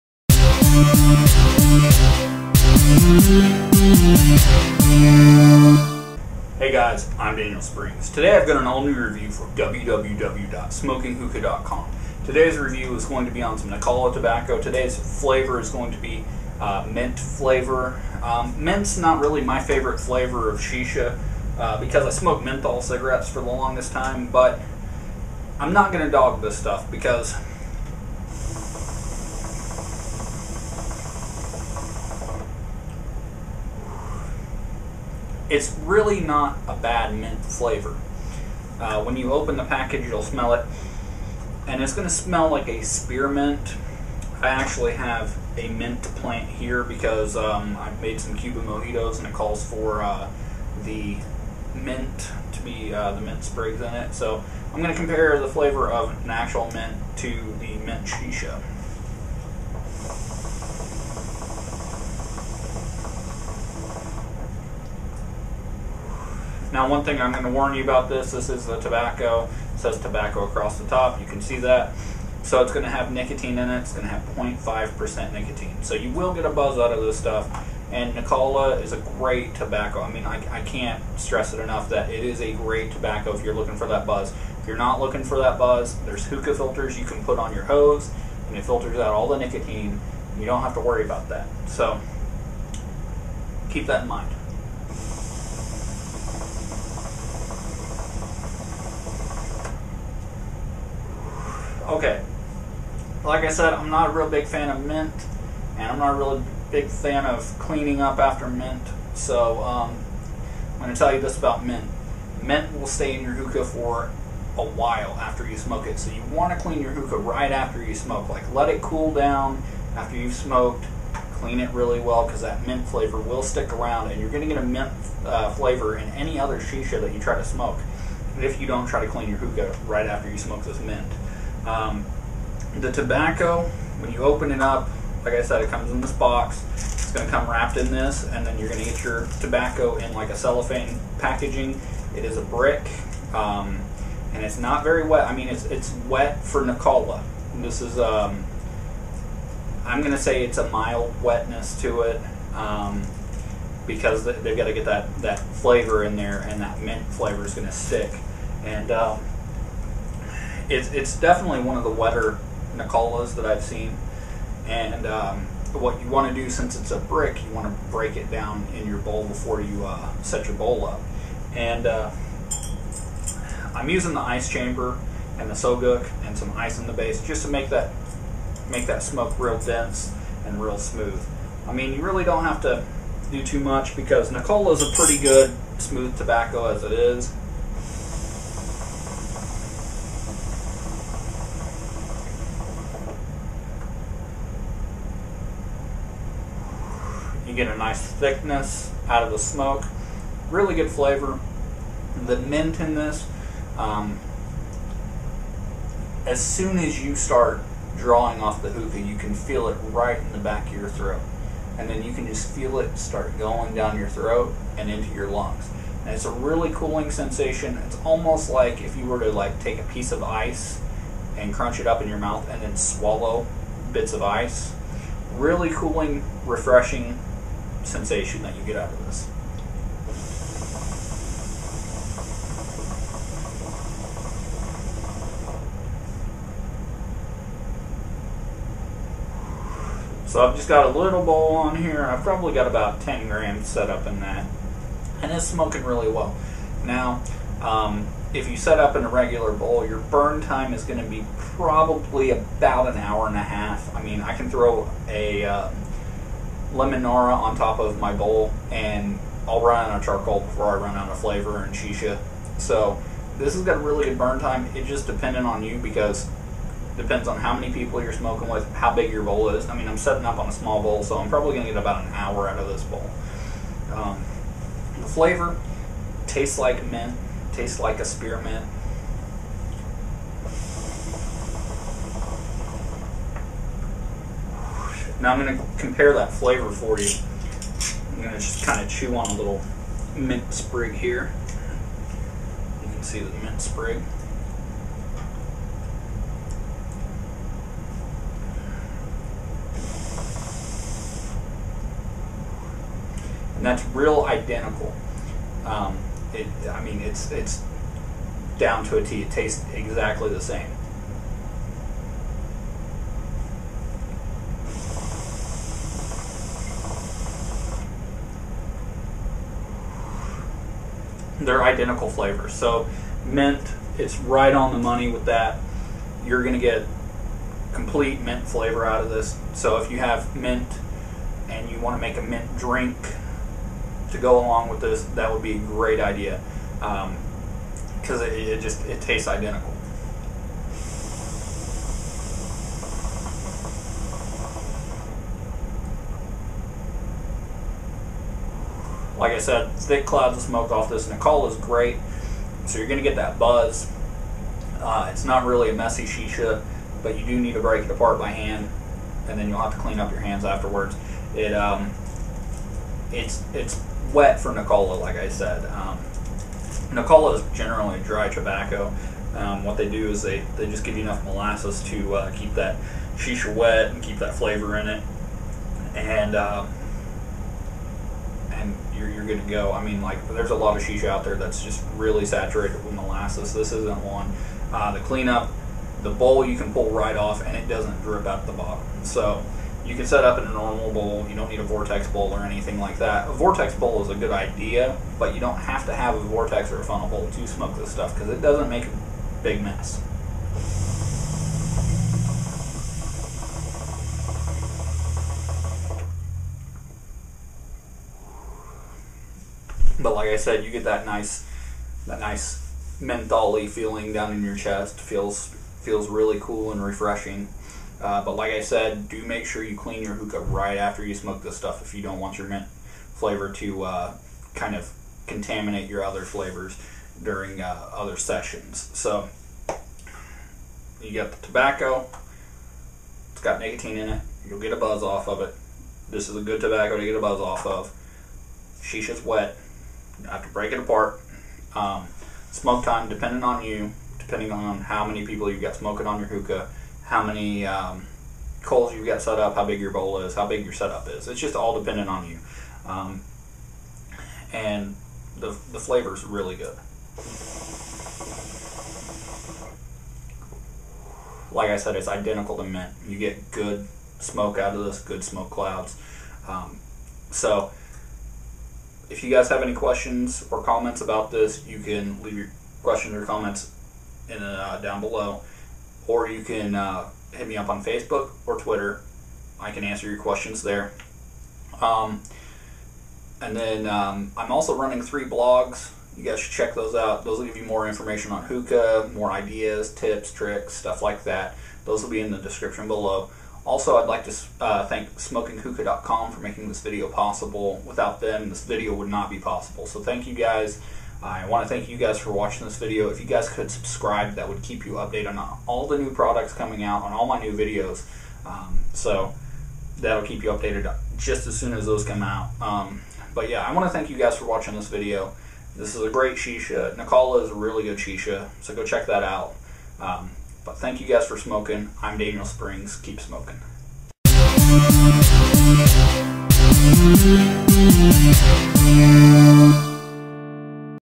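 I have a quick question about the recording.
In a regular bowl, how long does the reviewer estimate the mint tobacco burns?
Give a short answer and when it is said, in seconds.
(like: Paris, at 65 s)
an hour and a half, at 252 s.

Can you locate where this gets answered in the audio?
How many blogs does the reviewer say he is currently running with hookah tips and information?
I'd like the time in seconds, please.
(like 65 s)
485 s.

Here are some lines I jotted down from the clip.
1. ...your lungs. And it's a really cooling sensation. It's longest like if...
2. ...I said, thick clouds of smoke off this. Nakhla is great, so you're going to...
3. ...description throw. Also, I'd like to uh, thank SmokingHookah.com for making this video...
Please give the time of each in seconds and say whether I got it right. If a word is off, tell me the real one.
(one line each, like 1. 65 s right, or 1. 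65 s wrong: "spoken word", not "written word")
1. 215 s wrong: "almost", not "longest"
2. 349 s right
3. 492 s wrong: "below", not "throw".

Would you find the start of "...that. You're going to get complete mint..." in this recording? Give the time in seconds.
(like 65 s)
325 s.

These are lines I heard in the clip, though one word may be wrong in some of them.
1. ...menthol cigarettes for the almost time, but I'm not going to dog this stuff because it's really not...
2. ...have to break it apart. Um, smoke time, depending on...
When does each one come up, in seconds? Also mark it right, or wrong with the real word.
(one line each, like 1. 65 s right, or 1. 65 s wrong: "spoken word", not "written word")
1. 22 s wrong: "longest", not "almost"
2. 440 s right.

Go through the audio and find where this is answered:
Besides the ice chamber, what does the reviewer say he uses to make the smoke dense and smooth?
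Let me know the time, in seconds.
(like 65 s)
175 s.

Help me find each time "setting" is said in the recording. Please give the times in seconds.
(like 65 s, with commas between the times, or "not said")
269 s.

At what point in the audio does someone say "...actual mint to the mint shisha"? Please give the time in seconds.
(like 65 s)
56 s.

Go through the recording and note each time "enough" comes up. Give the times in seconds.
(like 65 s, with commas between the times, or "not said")
81 s, 371 s.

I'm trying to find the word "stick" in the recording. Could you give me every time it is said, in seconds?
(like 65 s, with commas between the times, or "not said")
123 s, 157 s.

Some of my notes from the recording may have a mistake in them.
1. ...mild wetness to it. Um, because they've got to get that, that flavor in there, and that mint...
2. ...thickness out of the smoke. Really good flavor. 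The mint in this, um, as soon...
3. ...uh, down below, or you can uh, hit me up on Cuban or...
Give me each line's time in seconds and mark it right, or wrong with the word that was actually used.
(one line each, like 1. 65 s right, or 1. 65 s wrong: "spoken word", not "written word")
1. 150 s right
2. 198 s right
3. 474 s wrong: "Facebook", not "Cuban".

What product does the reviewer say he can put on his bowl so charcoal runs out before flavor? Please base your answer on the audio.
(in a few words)
Lemonara.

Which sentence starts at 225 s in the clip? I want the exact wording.
Really cooling, refreshing, sensation that you get out of this.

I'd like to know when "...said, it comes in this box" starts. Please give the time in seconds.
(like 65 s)
135 s.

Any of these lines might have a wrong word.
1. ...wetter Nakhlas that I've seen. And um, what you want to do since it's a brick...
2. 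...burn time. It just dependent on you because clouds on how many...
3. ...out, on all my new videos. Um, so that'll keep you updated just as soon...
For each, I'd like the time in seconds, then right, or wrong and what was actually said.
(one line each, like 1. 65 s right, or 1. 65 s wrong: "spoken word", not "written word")
1. 161 s right
2. 264 s wrong: "depends", not "clouds"
3. 506 s right.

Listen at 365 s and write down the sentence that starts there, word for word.
Um, Nakhla is generally dry tobacco.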